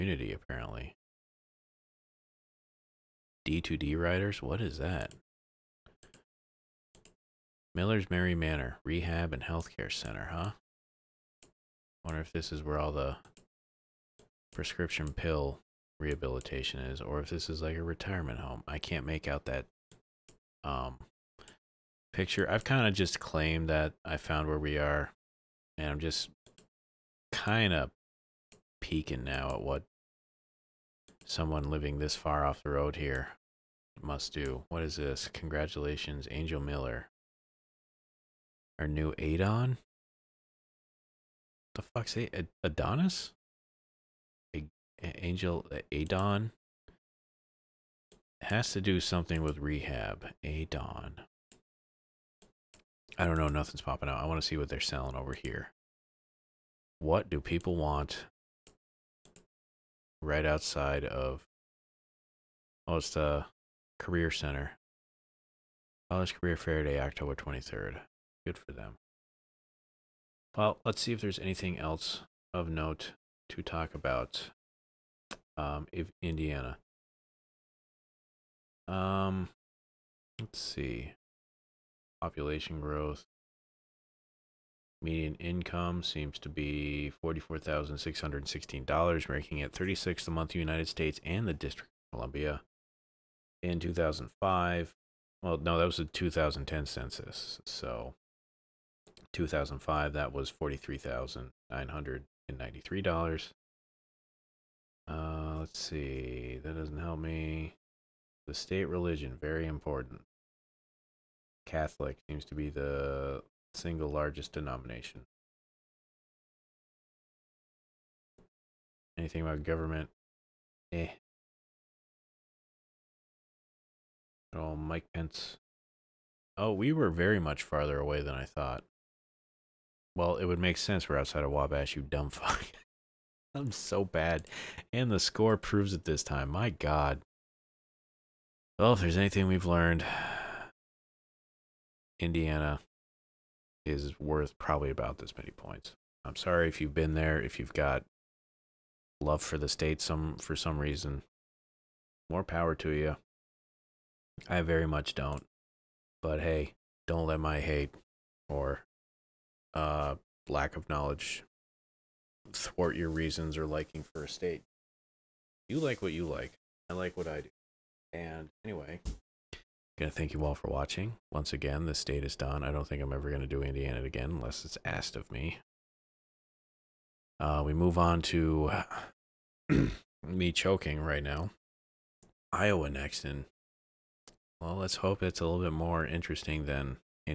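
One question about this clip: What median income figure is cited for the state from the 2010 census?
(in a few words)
$44,616.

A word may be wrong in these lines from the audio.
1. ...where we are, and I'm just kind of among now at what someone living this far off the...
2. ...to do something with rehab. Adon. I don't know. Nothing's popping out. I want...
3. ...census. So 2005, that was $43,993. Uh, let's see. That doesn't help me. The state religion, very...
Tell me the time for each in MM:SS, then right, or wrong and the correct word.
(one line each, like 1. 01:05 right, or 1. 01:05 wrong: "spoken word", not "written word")
1. 00:24 wrong: "peeking", not "among"
2. 00:48 right
3. 01:36 right.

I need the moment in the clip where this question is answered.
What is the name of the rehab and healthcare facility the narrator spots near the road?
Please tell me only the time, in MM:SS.
00:07.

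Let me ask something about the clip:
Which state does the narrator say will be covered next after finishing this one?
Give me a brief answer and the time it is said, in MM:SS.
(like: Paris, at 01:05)
Iowa, at 03:02.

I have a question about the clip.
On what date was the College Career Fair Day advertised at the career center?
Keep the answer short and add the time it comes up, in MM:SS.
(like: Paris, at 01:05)
October 23, at 01:06.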